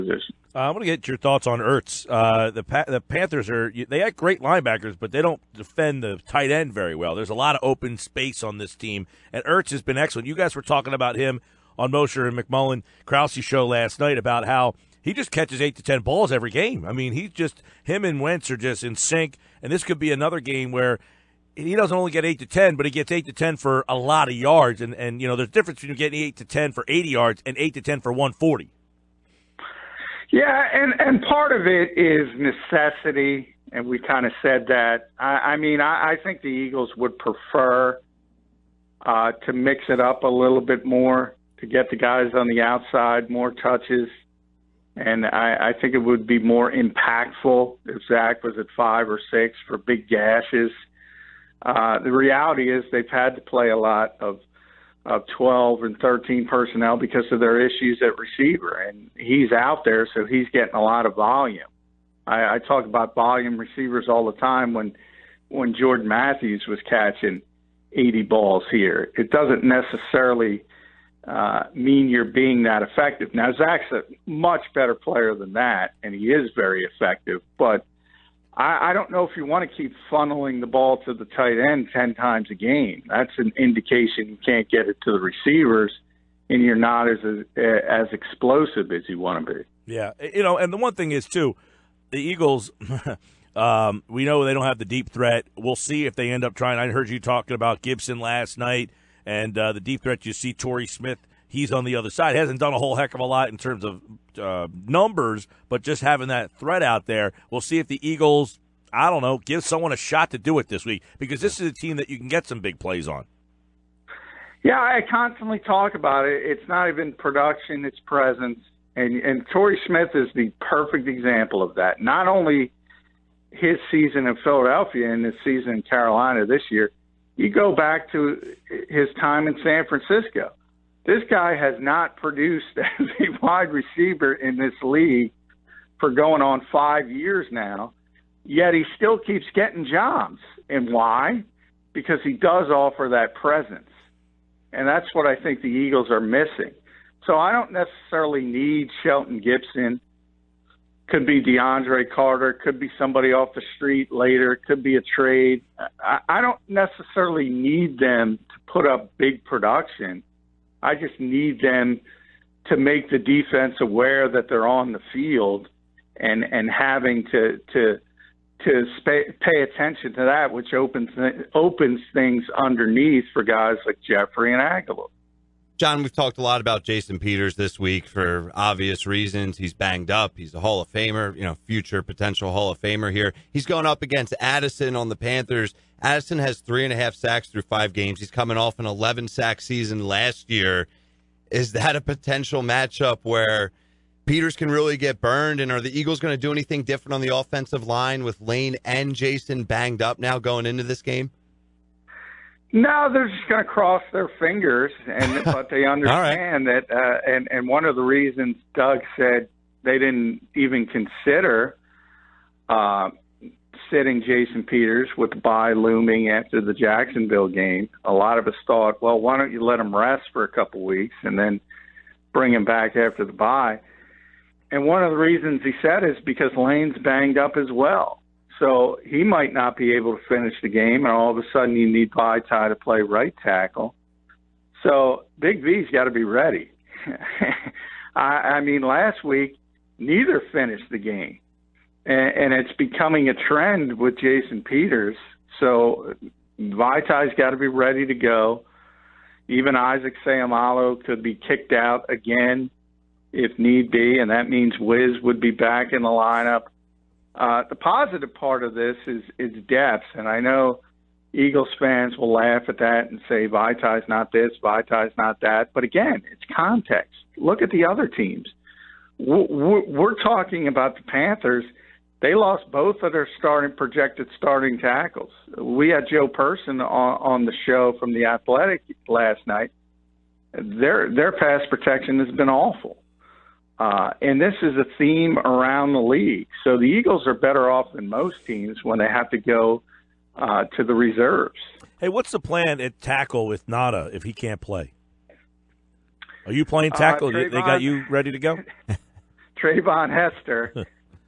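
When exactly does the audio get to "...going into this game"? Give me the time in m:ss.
3:20.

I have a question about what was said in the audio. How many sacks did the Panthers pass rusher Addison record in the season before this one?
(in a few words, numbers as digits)
11.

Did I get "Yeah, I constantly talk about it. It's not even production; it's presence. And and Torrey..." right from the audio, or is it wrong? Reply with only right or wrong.
right.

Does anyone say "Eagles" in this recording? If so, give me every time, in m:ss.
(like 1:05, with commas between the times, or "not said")
0:36, 1:32, 1:48, 2:25, 3:15, 4:21, 4:46.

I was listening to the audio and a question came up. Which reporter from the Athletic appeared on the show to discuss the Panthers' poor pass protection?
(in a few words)
Joe Person.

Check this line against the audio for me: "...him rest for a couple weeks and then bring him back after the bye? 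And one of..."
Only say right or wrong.
right.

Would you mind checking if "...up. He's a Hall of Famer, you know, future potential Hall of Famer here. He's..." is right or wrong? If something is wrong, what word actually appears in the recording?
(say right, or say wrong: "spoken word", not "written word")
right.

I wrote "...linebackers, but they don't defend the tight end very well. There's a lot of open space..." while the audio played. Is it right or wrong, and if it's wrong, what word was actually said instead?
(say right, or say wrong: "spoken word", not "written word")
right.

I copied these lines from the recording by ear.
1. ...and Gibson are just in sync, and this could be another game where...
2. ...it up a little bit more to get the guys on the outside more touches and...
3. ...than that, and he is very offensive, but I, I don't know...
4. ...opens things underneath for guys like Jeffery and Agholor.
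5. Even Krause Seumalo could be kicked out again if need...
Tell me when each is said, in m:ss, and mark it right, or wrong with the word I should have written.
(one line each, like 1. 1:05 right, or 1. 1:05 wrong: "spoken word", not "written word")
1. 0:18 wrong: "Wentz", not "Gibson"
2. 0:39 right
3. 1:15 wrong: "effective", not "offensive"
4. 2:51 right
5. 4:09 wrong: "Isaac", not "Krause".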